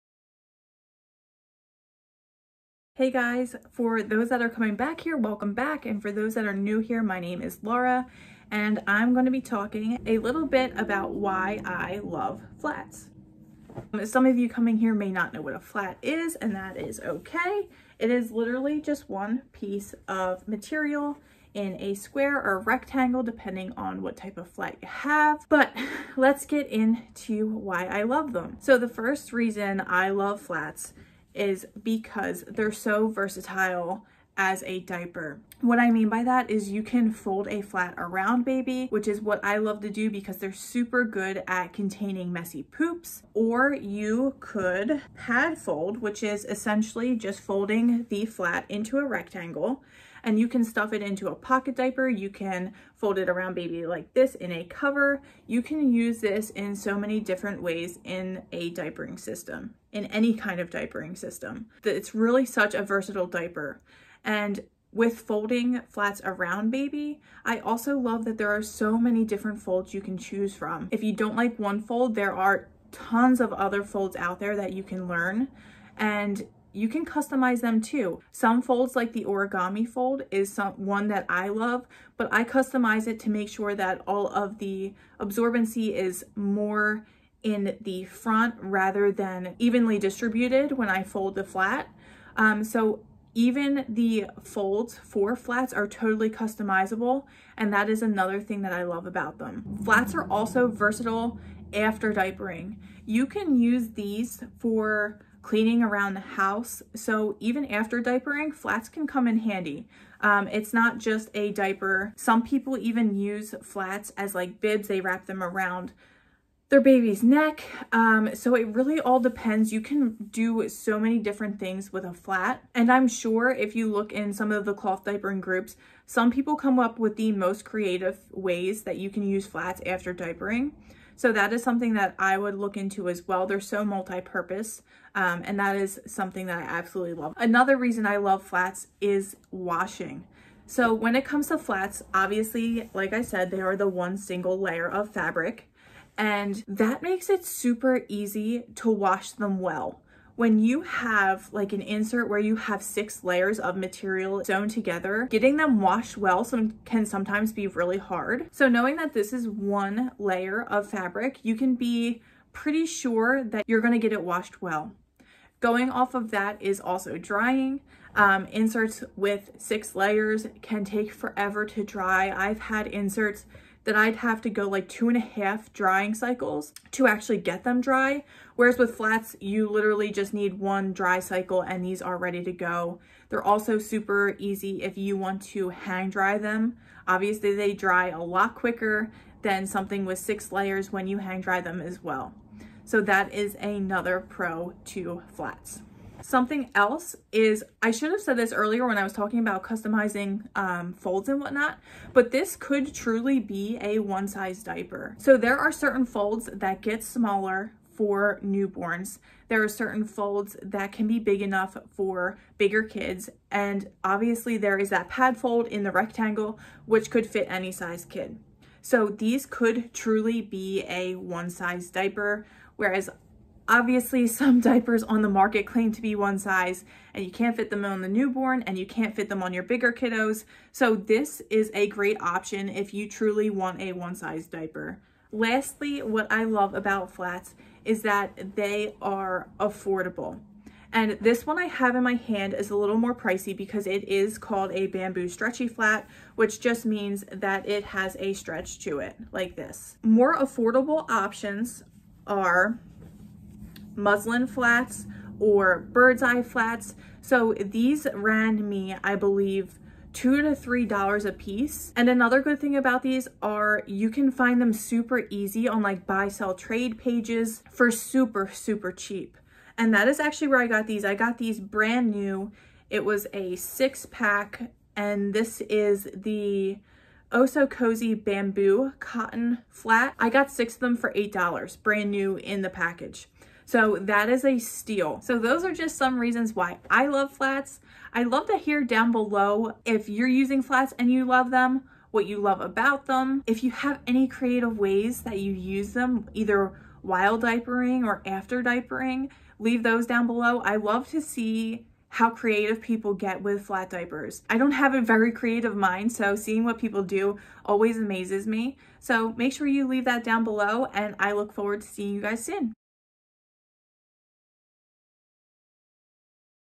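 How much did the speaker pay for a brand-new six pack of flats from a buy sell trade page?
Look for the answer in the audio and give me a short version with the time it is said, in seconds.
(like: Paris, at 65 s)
$8, at 281 s.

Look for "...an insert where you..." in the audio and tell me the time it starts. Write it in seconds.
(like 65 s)
151 s.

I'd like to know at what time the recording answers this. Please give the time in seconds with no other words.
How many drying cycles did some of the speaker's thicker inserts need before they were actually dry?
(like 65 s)
174 s.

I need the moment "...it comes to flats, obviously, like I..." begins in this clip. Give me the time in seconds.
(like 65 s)
141 s.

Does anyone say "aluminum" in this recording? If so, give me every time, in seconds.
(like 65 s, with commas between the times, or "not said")
not said.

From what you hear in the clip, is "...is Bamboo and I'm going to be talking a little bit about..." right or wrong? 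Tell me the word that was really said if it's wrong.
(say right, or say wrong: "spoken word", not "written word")
wrong: "Laura", not "Bamboo".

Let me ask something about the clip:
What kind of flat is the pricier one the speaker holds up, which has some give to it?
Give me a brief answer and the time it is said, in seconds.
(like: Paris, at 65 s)
bamboo stretchy flat, at 244 s.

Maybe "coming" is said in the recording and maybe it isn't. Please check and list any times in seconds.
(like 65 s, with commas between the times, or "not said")
4 s, 14 s.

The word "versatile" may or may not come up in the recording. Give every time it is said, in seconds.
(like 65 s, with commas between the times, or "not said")
33 s, 62 s, 100 s.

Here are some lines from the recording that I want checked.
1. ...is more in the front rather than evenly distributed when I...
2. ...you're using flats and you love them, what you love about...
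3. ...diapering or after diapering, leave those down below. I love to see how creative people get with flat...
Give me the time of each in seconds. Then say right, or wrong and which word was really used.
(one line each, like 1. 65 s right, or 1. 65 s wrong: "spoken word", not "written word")
1. 85 s right
2. 290 s right
3. 297 s right.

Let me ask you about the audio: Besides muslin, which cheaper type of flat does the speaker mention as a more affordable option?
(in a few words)
bird's eye.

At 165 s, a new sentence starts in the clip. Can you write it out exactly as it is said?
Going off of that is also drying.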